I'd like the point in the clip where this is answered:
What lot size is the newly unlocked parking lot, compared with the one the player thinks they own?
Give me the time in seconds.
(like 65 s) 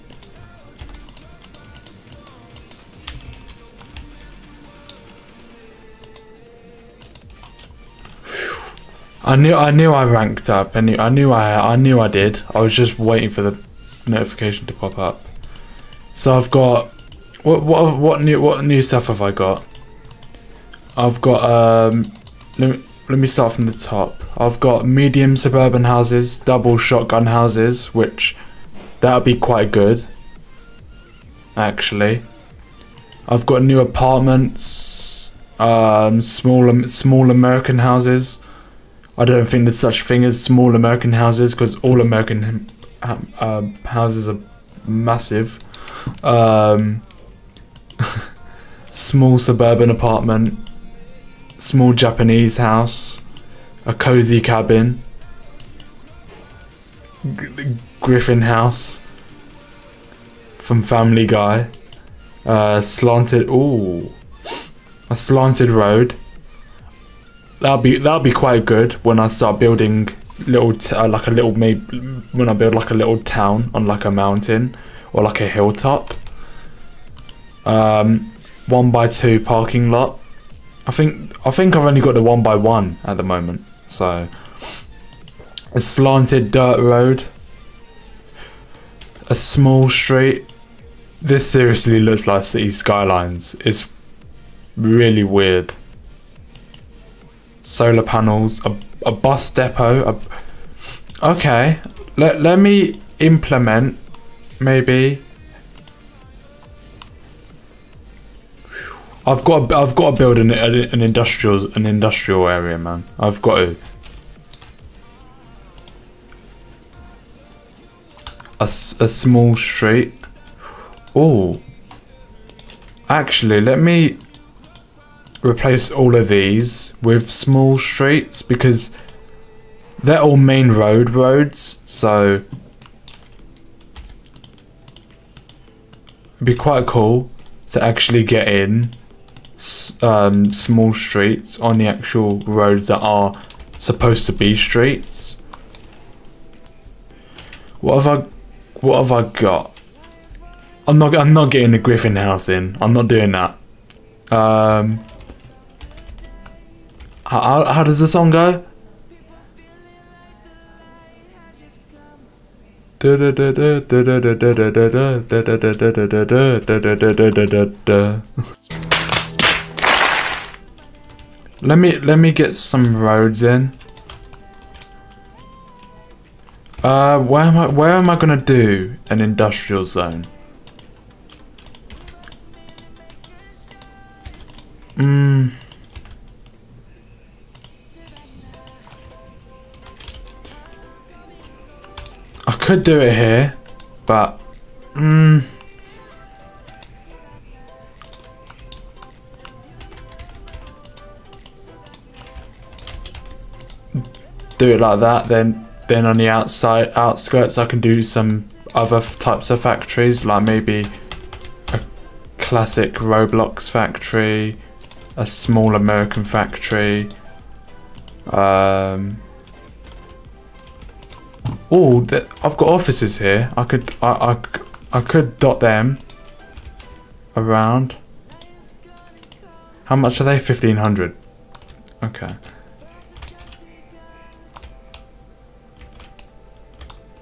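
78 s.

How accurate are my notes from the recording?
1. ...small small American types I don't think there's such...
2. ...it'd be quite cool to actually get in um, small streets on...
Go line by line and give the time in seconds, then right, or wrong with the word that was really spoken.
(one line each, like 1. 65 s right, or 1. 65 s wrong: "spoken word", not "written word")
1. 36 s wrong: "houses", not "types"
2. 136 s right.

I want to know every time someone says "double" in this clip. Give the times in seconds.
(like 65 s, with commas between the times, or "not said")
26 s.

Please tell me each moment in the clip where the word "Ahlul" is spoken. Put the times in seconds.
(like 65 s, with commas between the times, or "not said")
not said.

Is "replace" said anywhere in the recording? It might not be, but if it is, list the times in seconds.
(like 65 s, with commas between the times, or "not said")
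125 s.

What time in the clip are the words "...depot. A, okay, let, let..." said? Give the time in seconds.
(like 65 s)
99 s.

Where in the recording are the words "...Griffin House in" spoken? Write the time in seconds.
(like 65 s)
151 s.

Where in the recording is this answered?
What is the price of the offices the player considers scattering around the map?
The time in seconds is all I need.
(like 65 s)
230 s.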